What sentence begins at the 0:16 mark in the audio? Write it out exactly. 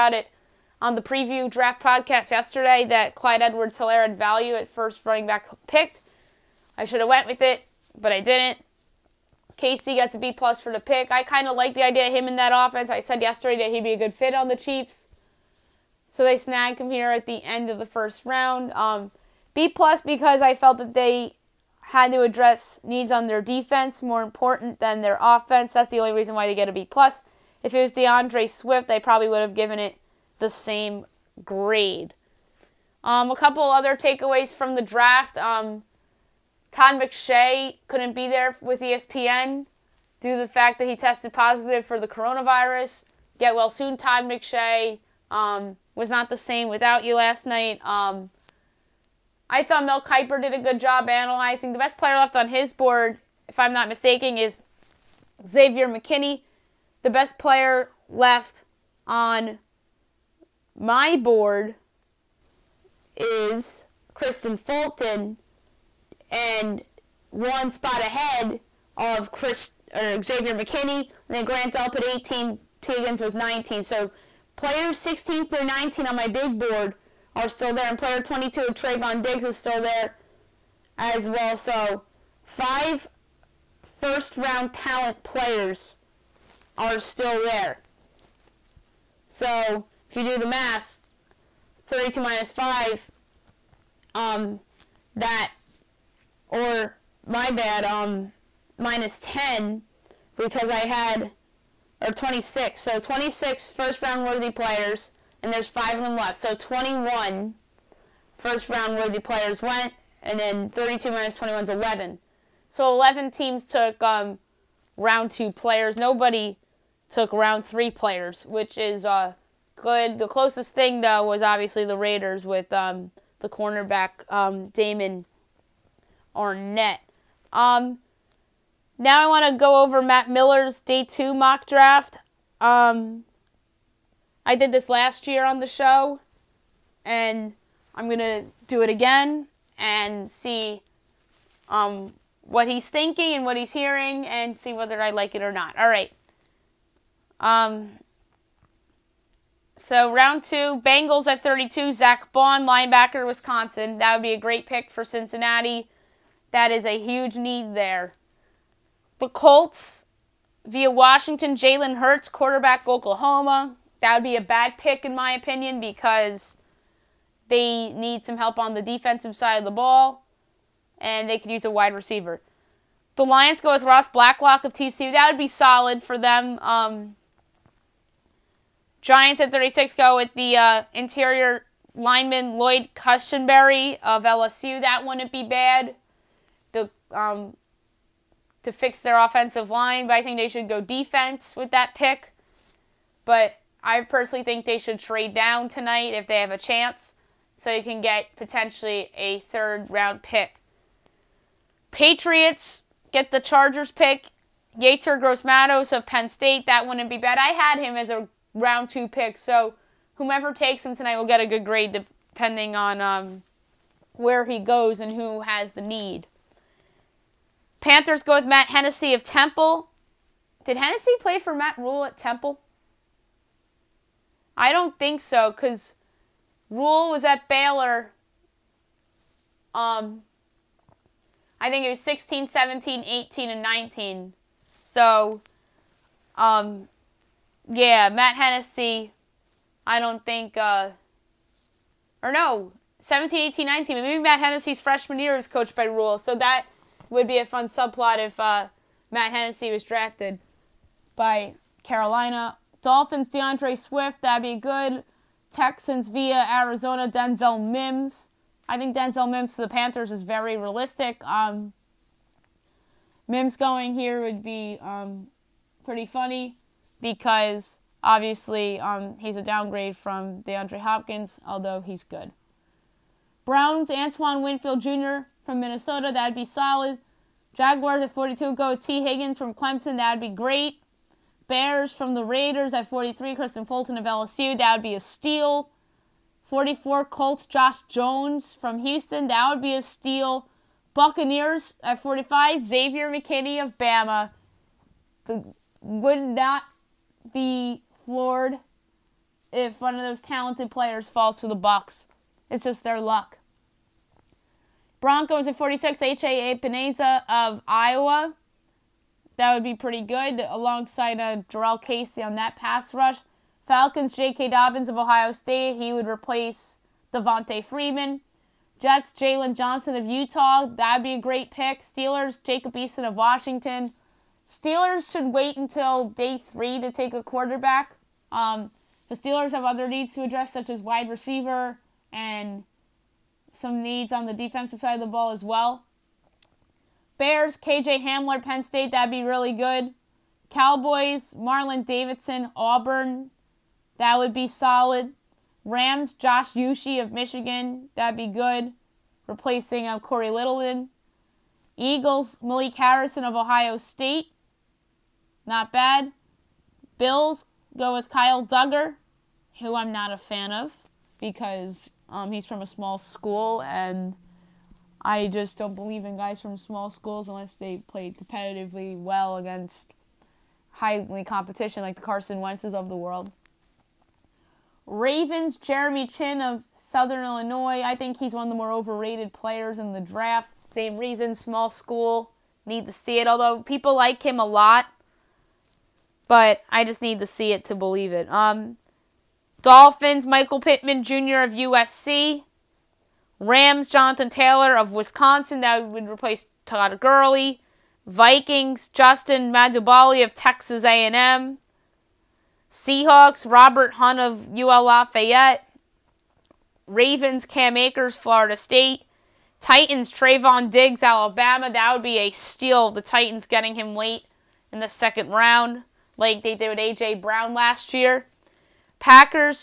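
So they snagged him here at the end of the first round.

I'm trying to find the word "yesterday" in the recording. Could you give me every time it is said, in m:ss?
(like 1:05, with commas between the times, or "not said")
0:02, 0:13.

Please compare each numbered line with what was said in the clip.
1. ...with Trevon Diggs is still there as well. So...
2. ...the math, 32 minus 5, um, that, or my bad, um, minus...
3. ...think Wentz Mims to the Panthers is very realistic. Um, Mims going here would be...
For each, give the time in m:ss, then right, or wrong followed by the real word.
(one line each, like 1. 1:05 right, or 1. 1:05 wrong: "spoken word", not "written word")
1. 1:18 right
2. 1:30 right
3. 4:18 wrong: "Denzel", not "Wentz".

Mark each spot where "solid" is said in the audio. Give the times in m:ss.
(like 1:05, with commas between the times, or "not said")
2:55, 4:36, 5:44.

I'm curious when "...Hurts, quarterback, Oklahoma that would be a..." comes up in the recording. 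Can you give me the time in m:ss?
2:41.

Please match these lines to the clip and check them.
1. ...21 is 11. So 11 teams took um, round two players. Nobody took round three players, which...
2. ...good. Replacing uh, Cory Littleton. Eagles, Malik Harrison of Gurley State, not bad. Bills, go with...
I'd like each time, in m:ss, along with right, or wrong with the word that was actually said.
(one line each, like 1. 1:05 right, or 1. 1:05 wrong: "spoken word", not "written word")
1. 1:51 right
2. 5:48 wrong: "Ohio", not "Gurley".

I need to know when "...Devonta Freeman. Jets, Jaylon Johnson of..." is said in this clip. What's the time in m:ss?
5:17.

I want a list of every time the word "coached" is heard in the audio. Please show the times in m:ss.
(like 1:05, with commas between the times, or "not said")
4:05.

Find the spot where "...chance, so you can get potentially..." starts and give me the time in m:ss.
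3:16.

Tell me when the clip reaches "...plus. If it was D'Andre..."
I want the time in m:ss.
0:26.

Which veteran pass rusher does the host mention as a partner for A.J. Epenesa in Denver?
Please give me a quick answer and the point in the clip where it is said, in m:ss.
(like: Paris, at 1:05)
Jurrell Casey, at 5:11.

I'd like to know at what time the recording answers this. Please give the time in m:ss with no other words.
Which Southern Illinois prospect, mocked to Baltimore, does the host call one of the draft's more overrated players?
6:15.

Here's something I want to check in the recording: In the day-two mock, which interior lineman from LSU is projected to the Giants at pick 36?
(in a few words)
Lloyd Cushenberry.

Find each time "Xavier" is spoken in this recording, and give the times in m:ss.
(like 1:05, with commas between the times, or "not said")
0:55, 1:10, 4:52.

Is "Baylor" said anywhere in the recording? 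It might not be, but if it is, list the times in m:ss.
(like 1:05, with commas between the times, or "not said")
3:47.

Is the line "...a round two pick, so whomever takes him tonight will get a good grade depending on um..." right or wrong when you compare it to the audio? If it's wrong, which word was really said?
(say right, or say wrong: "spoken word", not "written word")
right.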